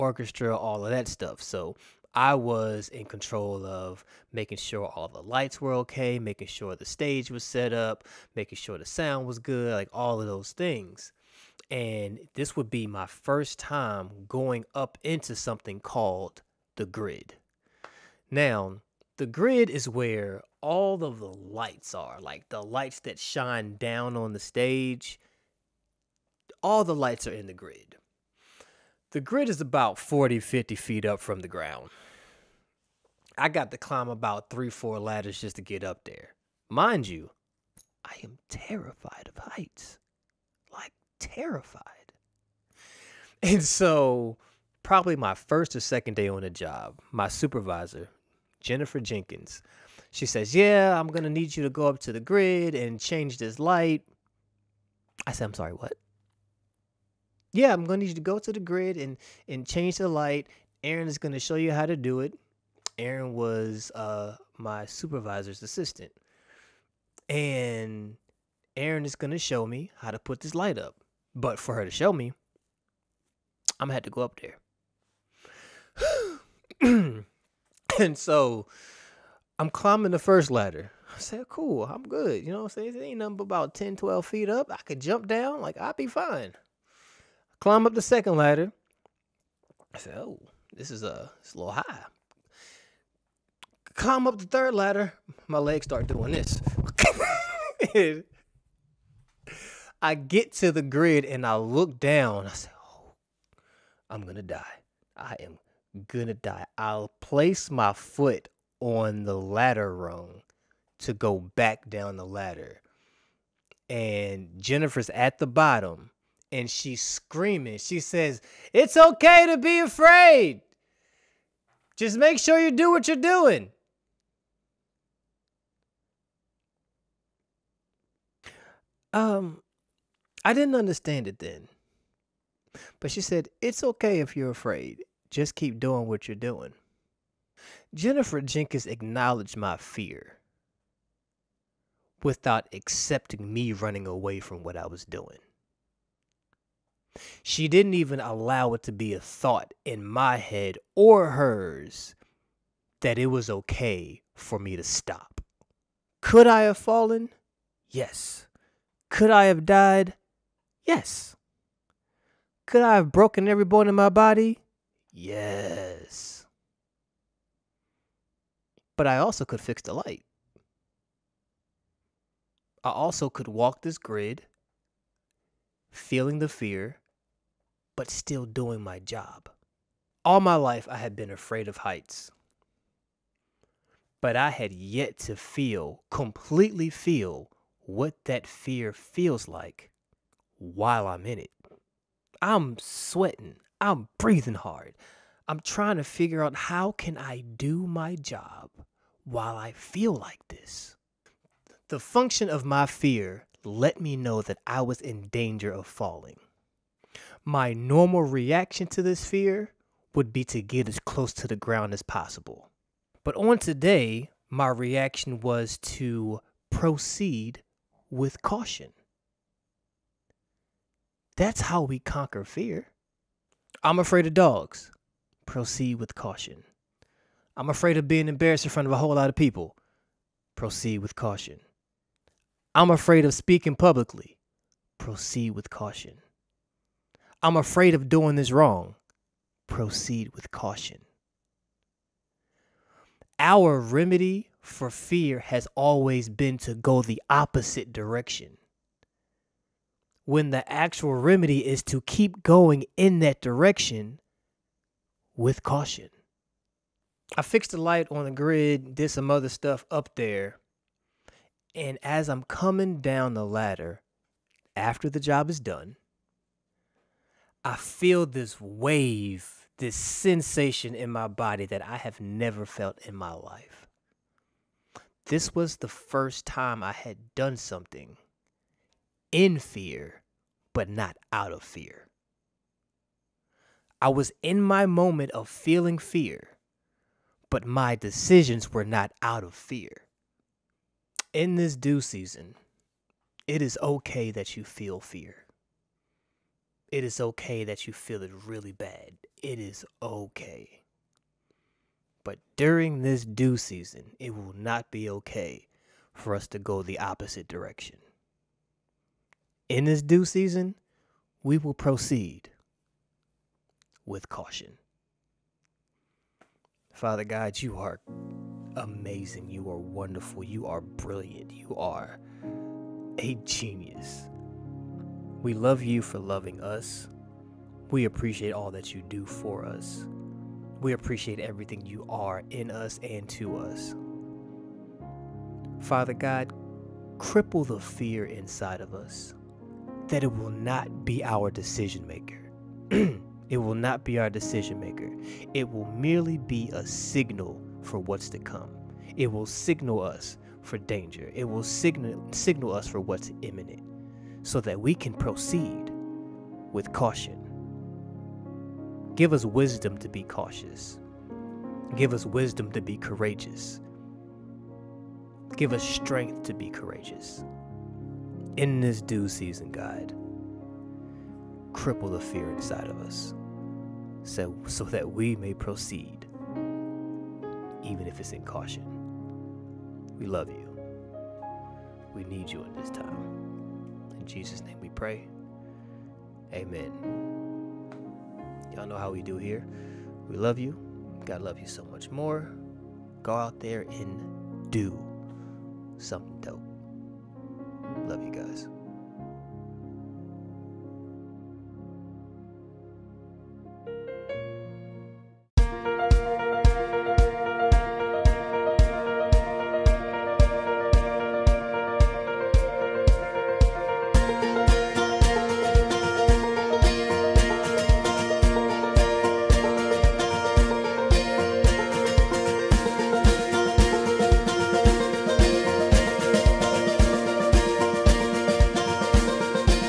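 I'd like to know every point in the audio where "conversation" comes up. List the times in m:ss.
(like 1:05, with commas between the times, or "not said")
not said.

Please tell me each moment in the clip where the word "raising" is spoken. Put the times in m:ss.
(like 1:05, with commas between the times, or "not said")
not said.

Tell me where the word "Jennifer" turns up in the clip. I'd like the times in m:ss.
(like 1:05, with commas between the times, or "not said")
0:48, 1:54, 2:17.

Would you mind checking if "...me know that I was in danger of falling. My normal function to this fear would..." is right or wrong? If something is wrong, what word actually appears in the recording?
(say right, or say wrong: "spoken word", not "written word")
wrong: "reaction", not "function".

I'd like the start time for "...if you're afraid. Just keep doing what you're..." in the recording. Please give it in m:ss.
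2:14.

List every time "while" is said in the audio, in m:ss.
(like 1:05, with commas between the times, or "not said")
3:10, 3:19.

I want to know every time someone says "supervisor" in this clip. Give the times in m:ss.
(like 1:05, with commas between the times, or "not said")
0:47, 1:04.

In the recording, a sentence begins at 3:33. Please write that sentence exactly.
But on today, my reaction was to proceed with caution.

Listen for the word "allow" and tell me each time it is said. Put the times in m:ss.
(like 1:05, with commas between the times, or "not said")
2:28.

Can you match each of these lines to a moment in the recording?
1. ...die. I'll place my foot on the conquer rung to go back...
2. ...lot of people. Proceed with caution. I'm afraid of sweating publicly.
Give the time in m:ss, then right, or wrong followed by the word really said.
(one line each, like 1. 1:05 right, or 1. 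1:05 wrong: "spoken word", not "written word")
1. 1:46 wrong: "ladder", not "conquer"
2. 3:49 wrong: "speaking", not "sweating".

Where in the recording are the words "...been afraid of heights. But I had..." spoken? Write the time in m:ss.
3:01.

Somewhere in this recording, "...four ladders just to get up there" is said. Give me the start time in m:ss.
0:34.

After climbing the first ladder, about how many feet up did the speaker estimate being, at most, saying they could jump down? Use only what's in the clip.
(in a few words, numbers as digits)
12.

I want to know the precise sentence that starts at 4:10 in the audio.
When the actual remedy is to keep going in that direction with caution.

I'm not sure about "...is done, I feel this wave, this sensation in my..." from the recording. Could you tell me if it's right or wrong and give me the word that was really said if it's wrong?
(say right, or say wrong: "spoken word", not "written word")
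right.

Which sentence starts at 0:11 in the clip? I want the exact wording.
And this would be my first time going up into something called the grid.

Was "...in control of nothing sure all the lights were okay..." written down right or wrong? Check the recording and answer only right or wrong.
wrong.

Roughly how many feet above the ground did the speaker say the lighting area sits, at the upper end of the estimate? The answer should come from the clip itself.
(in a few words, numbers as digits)
50.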